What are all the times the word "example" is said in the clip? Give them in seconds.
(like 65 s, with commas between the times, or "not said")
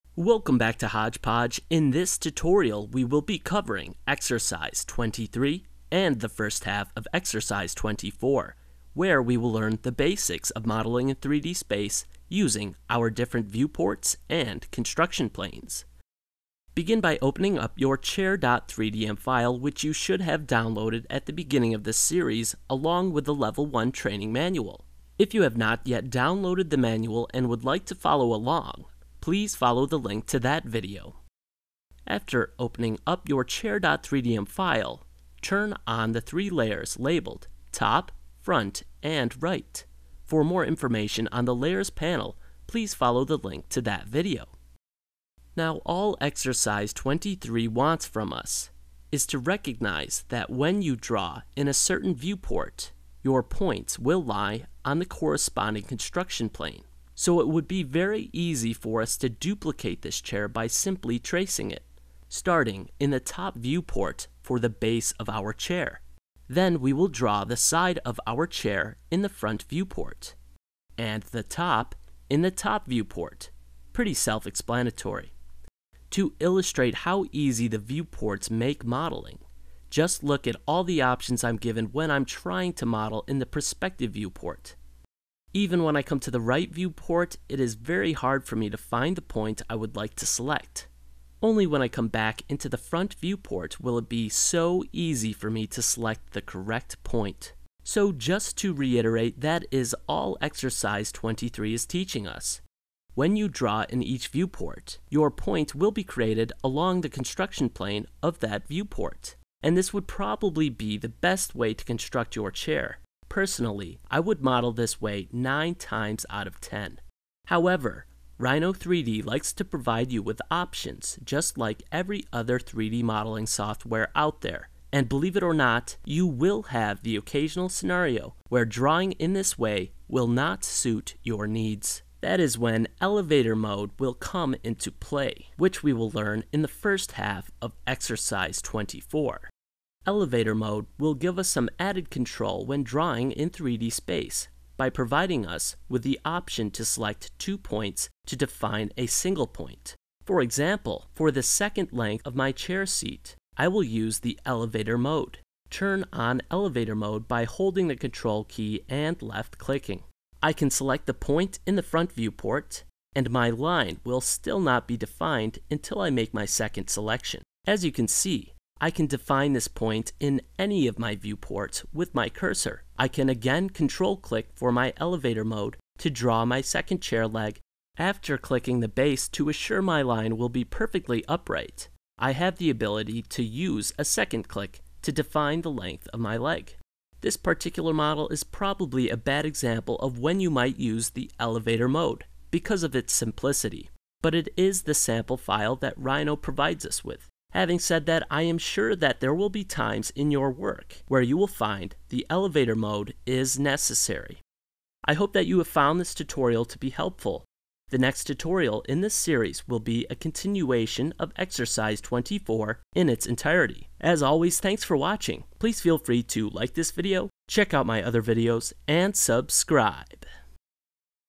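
150 s, 189 s.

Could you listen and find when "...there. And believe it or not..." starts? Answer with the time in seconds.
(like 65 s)
124 s.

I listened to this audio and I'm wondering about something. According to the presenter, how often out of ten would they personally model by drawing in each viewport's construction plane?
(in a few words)
9.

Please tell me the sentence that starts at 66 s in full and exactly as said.
Then we will draw the side of our chair in the front viewport, and the top in the top viewport.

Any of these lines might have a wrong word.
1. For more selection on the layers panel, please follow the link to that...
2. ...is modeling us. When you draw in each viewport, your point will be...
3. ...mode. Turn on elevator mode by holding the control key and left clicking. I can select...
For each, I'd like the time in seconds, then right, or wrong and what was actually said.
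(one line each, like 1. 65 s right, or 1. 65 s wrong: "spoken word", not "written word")
1. 40 s wrong: "information", not "selection"
2. 101 s wrong: "teaching", not "modeling"
3. 154 s right.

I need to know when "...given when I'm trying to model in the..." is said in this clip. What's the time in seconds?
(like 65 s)
81 s.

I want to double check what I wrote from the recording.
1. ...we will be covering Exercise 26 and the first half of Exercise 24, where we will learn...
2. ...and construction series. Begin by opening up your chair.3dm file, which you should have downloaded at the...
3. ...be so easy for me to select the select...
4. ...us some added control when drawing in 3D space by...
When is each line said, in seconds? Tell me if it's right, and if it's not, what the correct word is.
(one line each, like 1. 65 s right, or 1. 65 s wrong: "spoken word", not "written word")
1. 2 s wrong: "23", not "26"
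2. 14 s wrong: "planes", not "series"
3. 94 s wrong: "correct", not "select"
4. 141 s right.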